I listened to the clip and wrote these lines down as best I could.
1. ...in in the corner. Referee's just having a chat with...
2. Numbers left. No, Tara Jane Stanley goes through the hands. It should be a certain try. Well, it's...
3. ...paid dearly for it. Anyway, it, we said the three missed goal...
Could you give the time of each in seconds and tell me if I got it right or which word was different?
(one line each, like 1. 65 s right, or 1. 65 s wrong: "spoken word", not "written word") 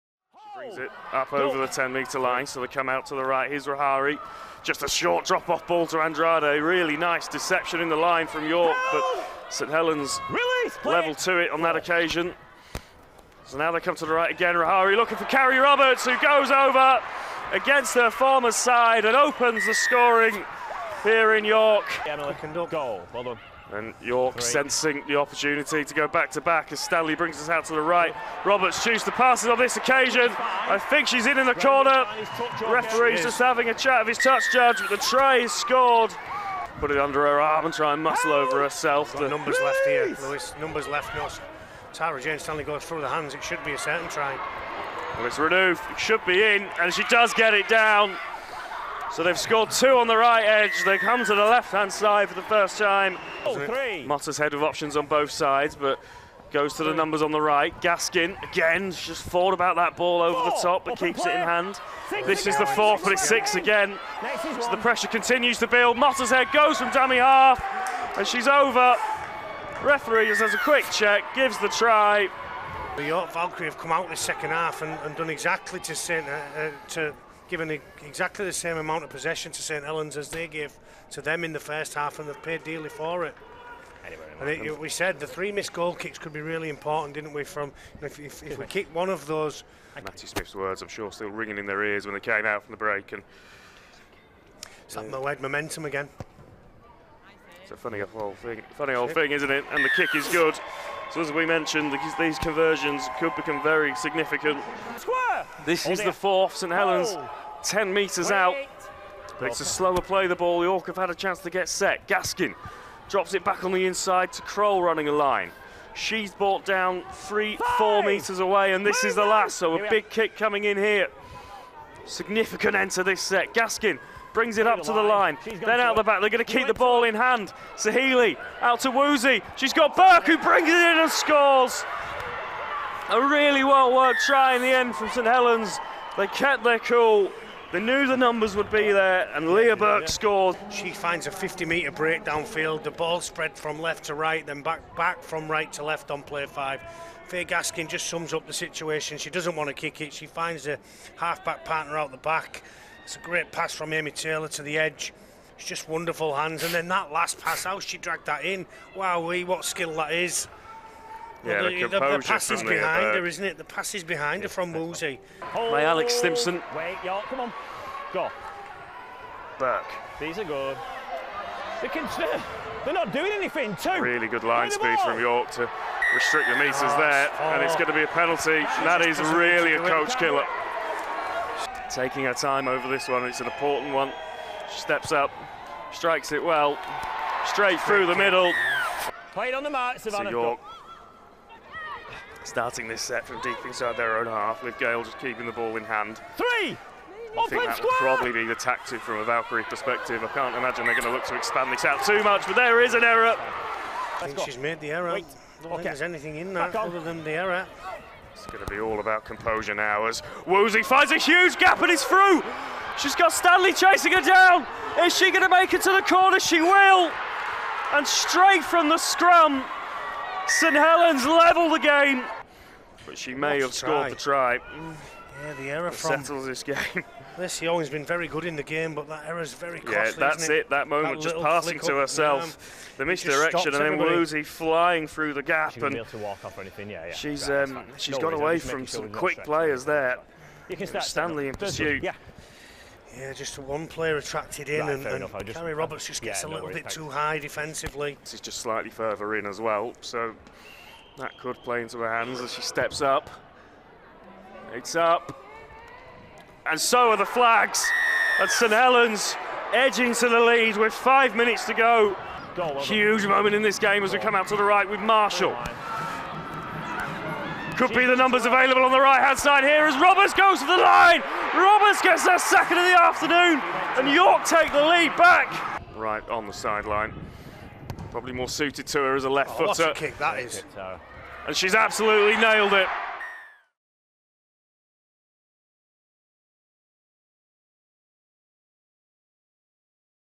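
1. 31 s right
2. 40 s right
3. 82 s right.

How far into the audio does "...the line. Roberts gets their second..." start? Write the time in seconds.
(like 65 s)
270 s.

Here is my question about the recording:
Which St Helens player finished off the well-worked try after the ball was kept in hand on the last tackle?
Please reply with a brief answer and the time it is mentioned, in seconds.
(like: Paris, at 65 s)
Leah Burke, at 139 s.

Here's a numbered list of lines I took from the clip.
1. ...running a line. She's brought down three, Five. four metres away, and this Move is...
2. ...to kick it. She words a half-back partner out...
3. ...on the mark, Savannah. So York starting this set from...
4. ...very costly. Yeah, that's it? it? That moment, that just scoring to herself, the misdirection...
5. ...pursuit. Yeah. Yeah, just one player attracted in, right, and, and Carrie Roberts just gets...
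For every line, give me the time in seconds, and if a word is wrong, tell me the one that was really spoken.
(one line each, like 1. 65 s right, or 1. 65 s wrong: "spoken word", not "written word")
1. 114 s right
2. 149 s wrong: "finds", not "words"
3. 189 s right
4. 229 s wrong: "passing", not "scoring"
5. 241 s right.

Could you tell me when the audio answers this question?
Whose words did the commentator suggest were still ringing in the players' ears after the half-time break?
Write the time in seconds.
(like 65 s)
89 s.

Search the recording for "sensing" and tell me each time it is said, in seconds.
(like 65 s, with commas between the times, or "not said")
24 s.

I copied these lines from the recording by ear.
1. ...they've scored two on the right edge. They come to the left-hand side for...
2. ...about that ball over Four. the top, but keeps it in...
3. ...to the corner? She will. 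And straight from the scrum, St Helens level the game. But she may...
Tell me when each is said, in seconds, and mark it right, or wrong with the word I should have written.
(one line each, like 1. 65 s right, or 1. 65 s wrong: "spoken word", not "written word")
1. 49 s right
2. 59 s right
3. 215 s right.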